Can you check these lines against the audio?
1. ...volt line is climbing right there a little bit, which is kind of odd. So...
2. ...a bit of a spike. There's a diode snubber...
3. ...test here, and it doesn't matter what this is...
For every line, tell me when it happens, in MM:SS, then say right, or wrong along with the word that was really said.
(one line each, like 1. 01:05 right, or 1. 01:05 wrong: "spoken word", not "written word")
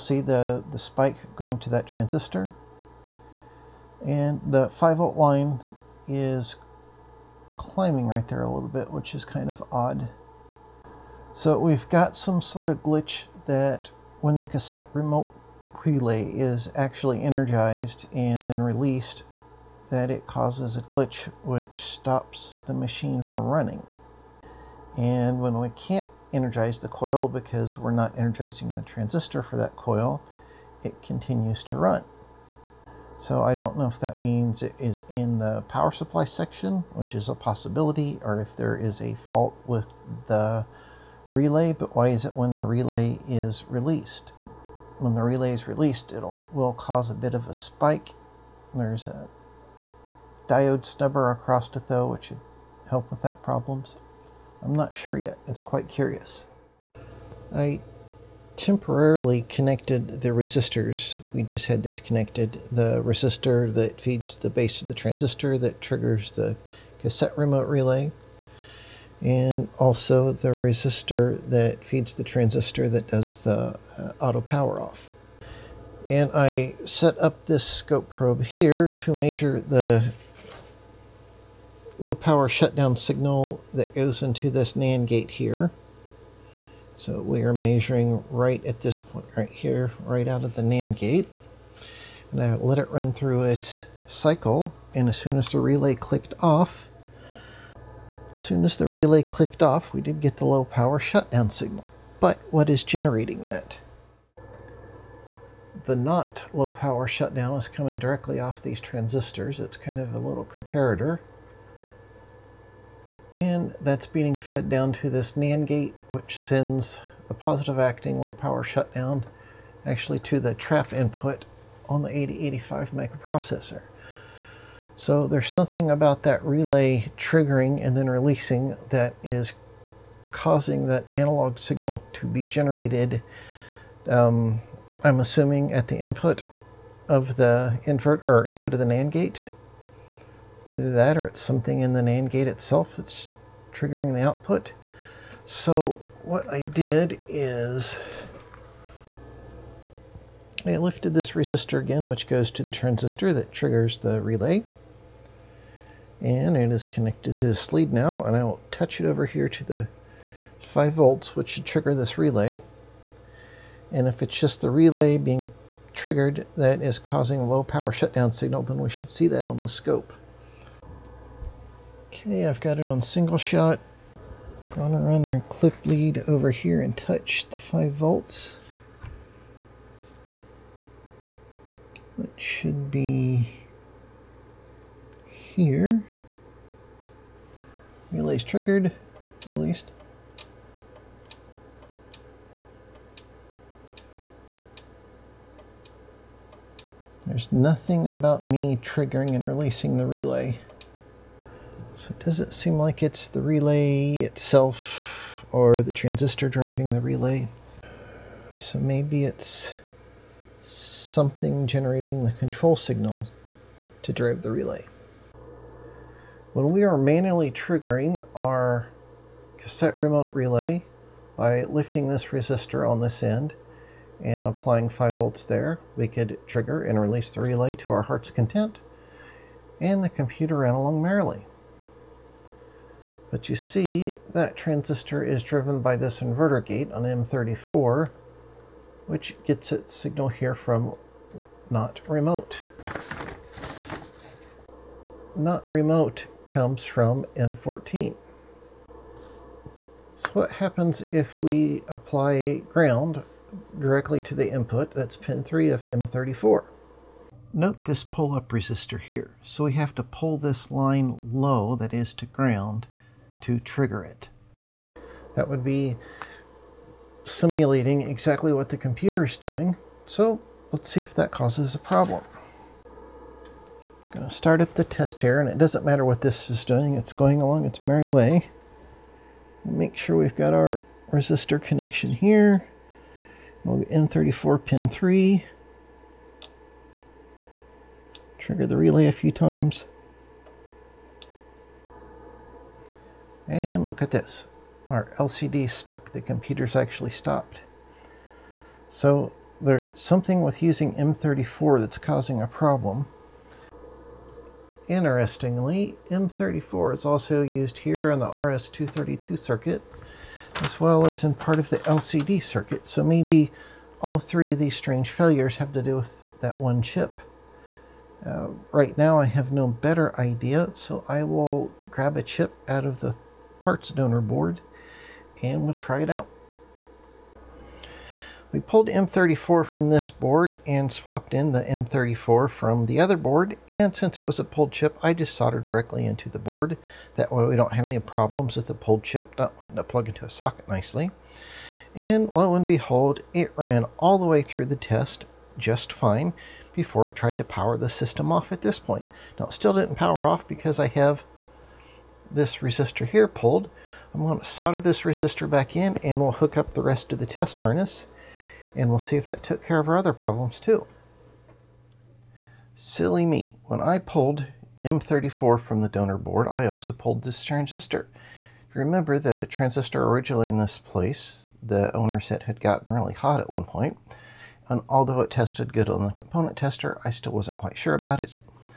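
1. 00:04 right
2. 00:47 right
3. 04:34 right.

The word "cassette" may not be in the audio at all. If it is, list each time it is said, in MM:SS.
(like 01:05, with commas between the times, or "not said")
00:14, 01:06, 03:39.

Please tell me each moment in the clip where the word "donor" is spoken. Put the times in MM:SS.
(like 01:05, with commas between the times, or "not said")
05:23, 06:05.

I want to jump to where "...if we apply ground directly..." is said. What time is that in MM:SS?
04:11.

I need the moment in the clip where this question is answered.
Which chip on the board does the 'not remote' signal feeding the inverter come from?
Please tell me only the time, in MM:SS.
04:07.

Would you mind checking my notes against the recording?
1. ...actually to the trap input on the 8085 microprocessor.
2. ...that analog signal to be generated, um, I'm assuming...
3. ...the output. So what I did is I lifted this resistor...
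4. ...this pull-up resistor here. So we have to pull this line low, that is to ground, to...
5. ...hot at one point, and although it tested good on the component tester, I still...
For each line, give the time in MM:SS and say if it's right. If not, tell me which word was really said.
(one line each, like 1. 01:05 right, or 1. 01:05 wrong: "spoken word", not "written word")
1. 01:59 right
2. 02:10 right
3. 02:24 right
4. 04:17 right
5. 06:13 right.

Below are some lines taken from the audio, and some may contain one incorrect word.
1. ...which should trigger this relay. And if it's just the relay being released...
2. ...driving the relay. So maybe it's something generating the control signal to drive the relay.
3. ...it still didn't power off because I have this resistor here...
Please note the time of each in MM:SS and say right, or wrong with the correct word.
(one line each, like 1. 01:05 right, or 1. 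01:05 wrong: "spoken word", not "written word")
1. 02:41 wrong: "triggered", not "released"
2. 03:26 right
3. 05:49 right.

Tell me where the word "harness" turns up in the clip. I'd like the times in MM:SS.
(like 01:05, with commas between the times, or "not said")
05:57.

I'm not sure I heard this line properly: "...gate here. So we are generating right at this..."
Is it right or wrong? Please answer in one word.
wrong.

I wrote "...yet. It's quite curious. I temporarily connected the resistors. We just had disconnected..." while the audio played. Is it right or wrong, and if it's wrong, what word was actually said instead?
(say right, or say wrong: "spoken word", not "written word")
right.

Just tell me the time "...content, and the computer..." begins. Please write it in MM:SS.
03:48.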